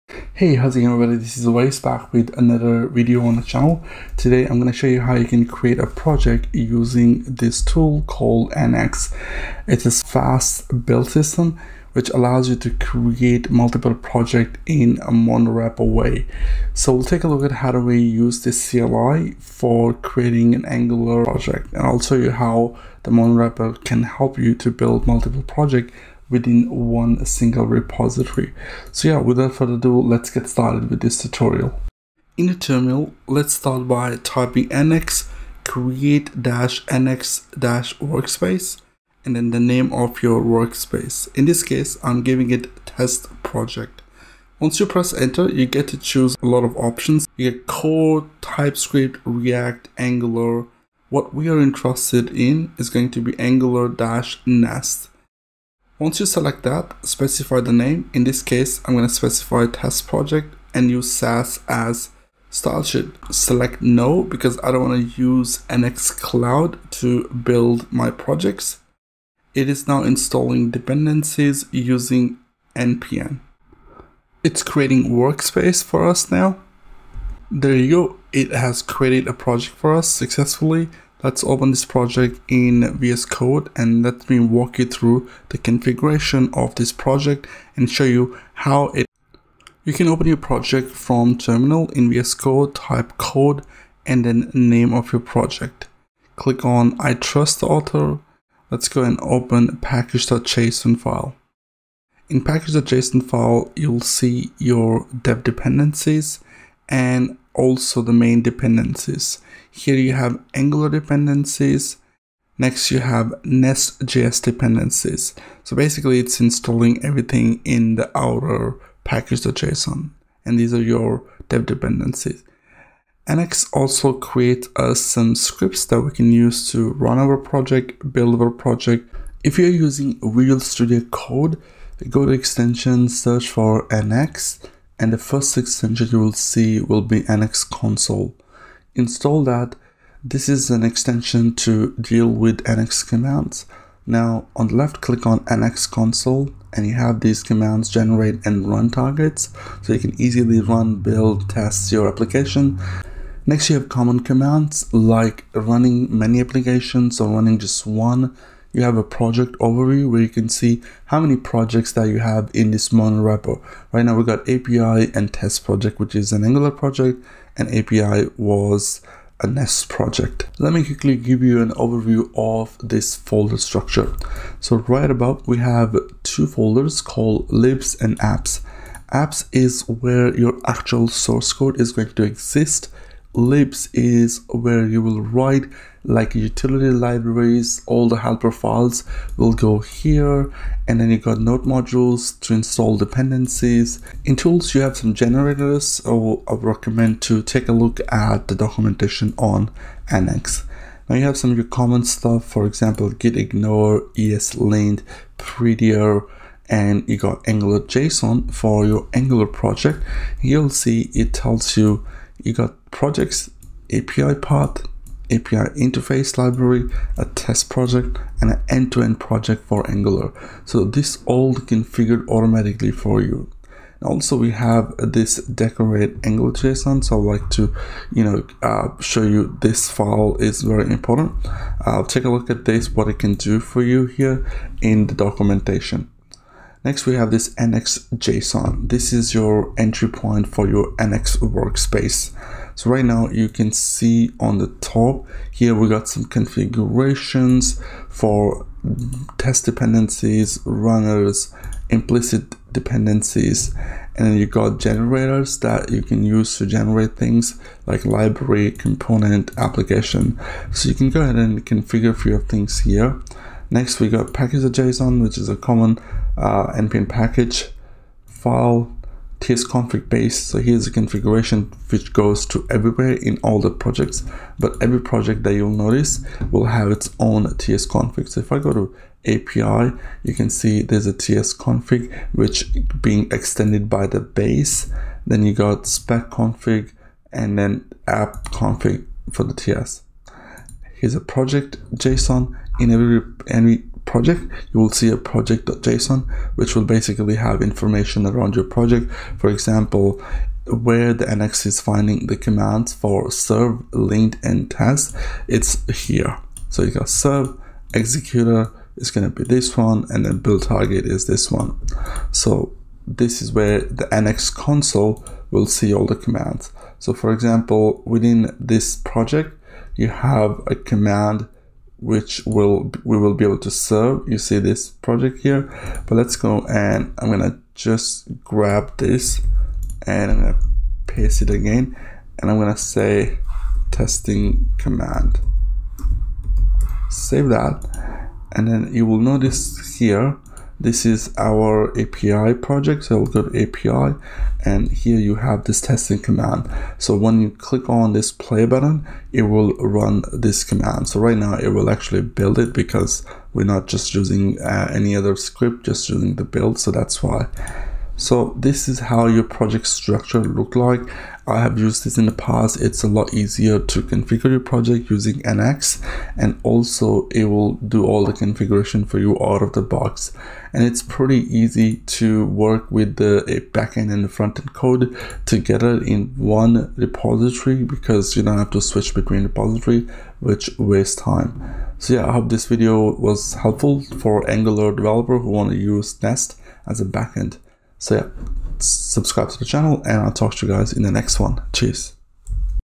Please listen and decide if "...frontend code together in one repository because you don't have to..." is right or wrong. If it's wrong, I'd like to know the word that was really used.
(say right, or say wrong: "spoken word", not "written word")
right.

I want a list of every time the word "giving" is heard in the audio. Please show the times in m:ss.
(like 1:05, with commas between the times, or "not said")
0:42.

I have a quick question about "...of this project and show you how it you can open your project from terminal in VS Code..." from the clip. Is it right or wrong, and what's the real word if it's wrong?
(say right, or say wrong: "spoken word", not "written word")
right.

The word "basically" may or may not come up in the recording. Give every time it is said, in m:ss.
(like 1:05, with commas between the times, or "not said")
1:55, 4:56.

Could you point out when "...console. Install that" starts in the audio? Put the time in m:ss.
2:17.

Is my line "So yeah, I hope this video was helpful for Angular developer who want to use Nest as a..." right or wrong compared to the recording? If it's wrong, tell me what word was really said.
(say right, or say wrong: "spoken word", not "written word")
right.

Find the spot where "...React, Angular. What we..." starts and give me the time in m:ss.
0:49.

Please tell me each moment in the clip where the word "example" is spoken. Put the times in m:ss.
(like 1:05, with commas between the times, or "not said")
3:22, 4:59, 5:17.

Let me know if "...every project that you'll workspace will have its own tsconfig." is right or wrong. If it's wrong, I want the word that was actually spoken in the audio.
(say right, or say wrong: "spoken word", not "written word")
wrong: "notice", not "workspace".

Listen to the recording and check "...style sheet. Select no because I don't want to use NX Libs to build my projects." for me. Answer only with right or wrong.
wrong.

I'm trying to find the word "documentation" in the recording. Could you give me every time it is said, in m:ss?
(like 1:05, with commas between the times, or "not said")
3:18, 3:55.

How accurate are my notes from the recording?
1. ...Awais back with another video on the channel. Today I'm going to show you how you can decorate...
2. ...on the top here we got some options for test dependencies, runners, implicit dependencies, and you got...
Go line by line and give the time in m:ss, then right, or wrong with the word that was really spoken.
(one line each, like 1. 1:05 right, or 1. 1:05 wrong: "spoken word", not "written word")
1. 0:01 wrong: "create", not "decorate"
2. 4:04 wrong: "configurations", not "options".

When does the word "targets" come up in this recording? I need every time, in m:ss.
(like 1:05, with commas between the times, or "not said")
2:28, 5:10.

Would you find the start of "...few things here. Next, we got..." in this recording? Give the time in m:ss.
4:22.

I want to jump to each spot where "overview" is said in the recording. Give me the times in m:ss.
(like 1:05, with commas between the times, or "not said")
2:39, 2:51.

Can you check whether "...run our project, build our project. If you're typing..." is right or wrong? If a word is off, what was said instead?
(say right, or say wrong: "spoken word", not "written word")
wrong: "using", not "typing".